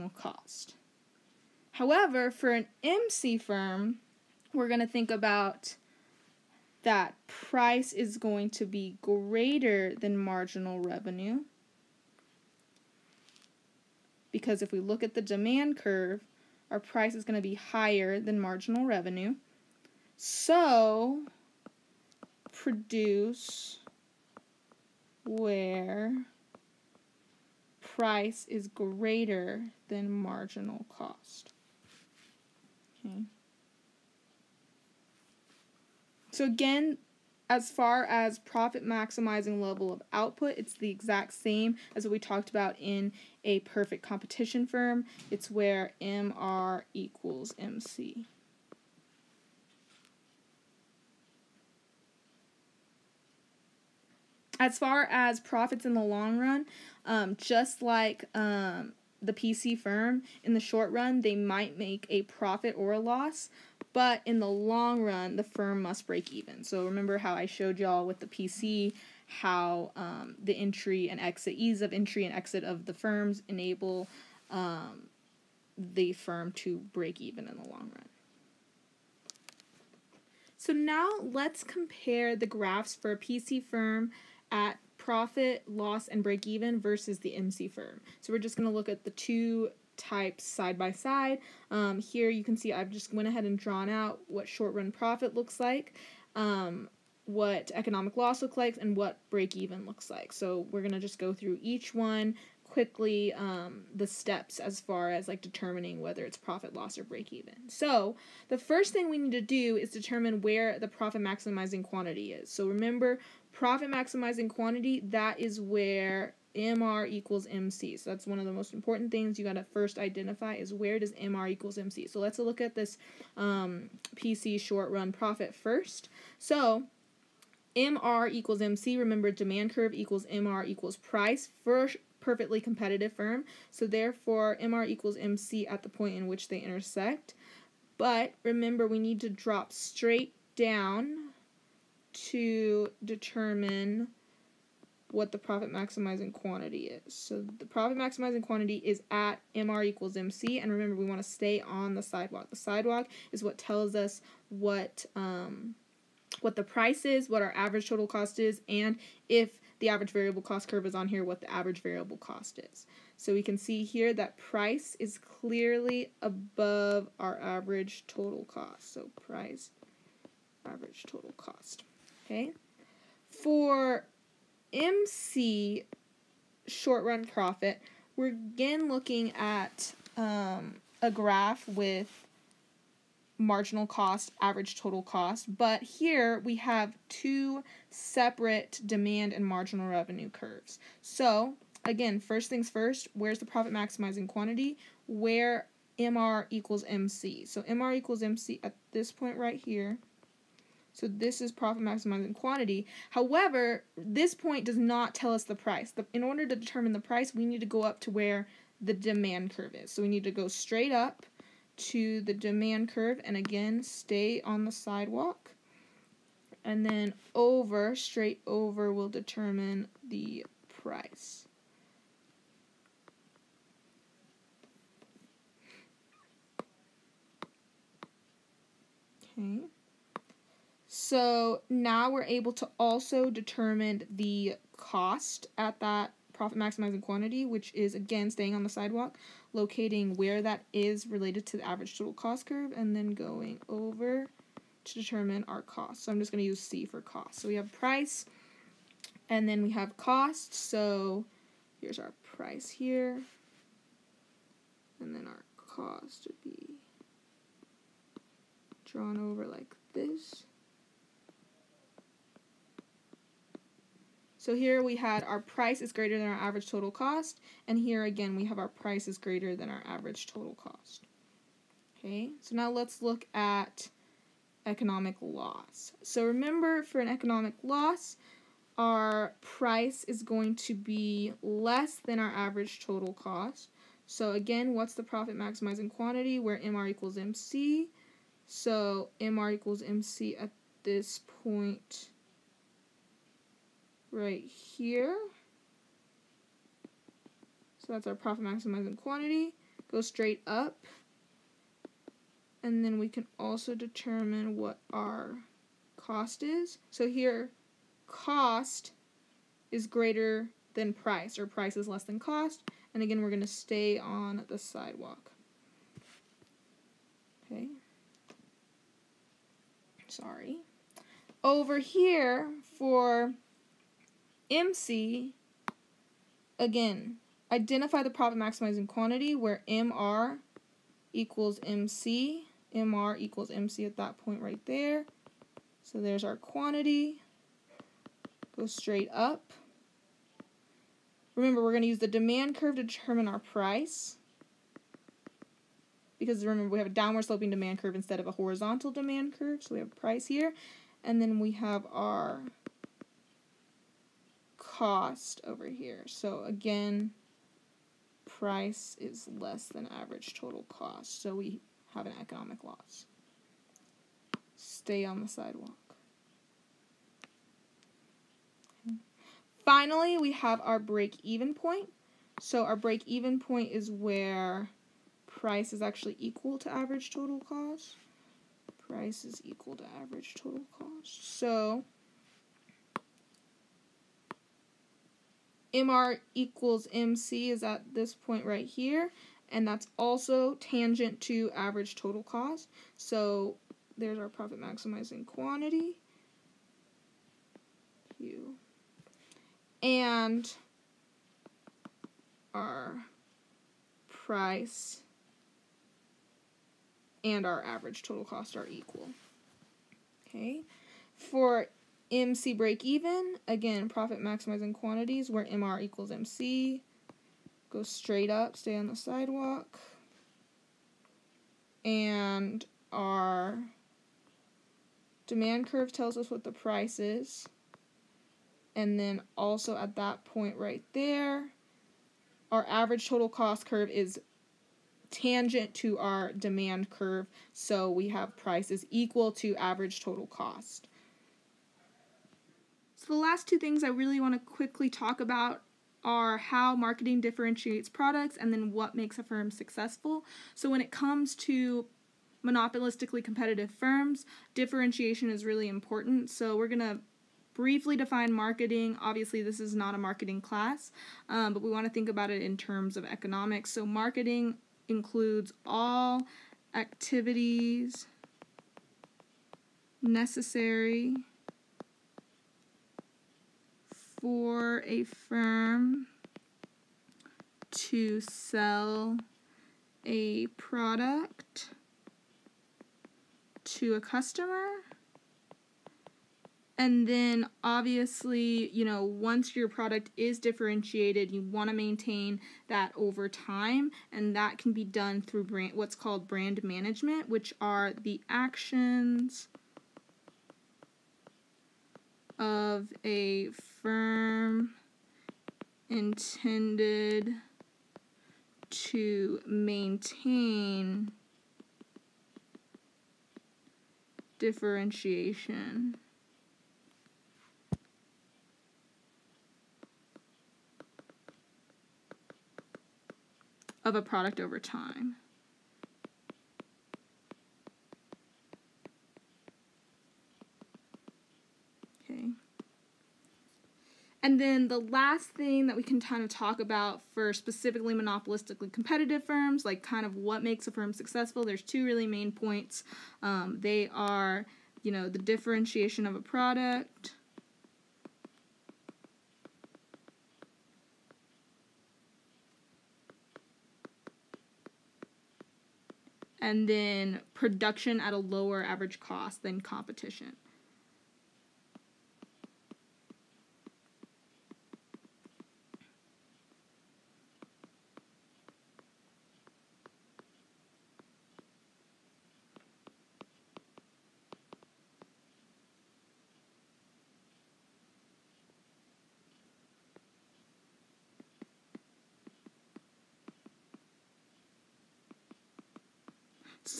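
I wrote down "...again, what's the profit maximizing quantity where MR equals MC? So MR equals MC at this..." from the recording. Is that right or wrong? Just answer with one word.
right.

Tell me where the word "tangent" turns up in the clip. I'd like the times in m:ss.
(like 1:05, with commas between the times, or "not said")
6:30, 7:15.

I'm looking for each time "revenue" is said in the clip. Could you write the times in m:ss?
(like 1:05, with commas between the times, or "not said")
0:10, 0:18, 3:09.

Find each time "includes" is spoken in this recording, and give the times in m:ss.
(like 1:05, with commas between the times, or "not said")
7:44.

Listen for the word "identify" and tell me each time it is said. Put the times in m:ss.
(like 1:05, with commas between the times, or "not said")
1:59, 5:27.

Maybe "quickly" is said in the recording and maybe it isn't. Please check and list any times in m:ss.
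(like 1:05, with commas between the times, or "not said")
1:42, 7:24.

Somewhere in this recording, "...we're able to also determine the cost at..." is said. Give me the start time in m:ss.
3:52.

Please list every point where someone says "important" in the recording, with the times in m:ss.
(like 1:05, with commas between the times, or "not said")
1:58, 7:35.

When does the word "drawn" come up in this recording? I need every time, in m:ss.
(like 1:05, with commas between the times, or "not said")
1:33, 4:18.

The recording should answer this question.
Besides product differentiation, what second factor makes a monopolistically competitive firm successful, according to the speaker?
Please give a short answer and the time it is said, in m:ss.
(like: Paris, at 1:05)
lower average cost than competition, at 9:17.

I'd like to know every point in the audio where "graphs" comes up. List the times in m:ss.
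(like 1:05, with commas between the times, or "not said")
1:22, 3:01.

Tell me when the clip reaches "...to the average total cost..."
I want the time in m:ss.
4:01.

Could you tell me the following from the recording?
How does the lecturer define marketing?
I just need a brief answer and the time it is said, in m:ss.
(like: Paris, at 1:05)
sell a product to a customer, at 7:58.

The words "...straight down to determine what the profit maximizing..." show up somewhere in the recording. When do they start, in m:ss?
2:19.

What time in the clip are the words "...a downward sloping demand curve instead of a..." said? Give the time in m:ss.
5:46.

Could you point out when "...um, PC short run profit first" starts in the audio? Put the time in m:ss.
2:03.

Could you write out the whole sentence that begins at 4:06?
So I'm just going to use C for cost.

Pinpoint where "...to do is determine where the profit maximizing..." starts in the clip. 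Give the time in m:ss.
1:49.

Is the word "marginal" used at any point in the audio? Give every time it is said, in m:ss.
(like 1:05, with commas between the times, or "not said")
0:10, 0:18, 0:30, 3:03, 3:09.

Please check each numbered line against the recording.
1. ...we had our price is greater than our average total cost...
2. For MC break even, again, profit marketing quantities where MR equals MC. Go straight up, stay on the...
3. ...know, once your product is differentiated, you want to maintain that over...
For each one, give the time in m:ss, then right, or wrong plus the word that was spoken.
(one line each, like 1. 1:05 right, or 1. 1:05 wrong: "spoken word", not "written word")
1. 4:24 right
2. 6:51 wrong: "maximizing", not "marketing"
3. 8:08 right.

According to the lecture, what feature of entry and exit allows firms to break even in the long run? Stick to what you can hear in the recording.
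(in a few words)
ease of entry and exit.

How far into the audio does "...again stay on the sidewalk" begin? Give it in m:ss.
3:33.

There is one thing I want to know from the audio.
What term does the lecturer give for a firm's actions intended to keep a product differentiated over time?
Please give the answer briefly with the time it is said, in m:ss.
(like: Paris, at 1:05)
brand management, at 8:16.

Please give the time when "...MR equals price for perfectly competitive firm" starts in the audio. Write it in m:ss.
2:10.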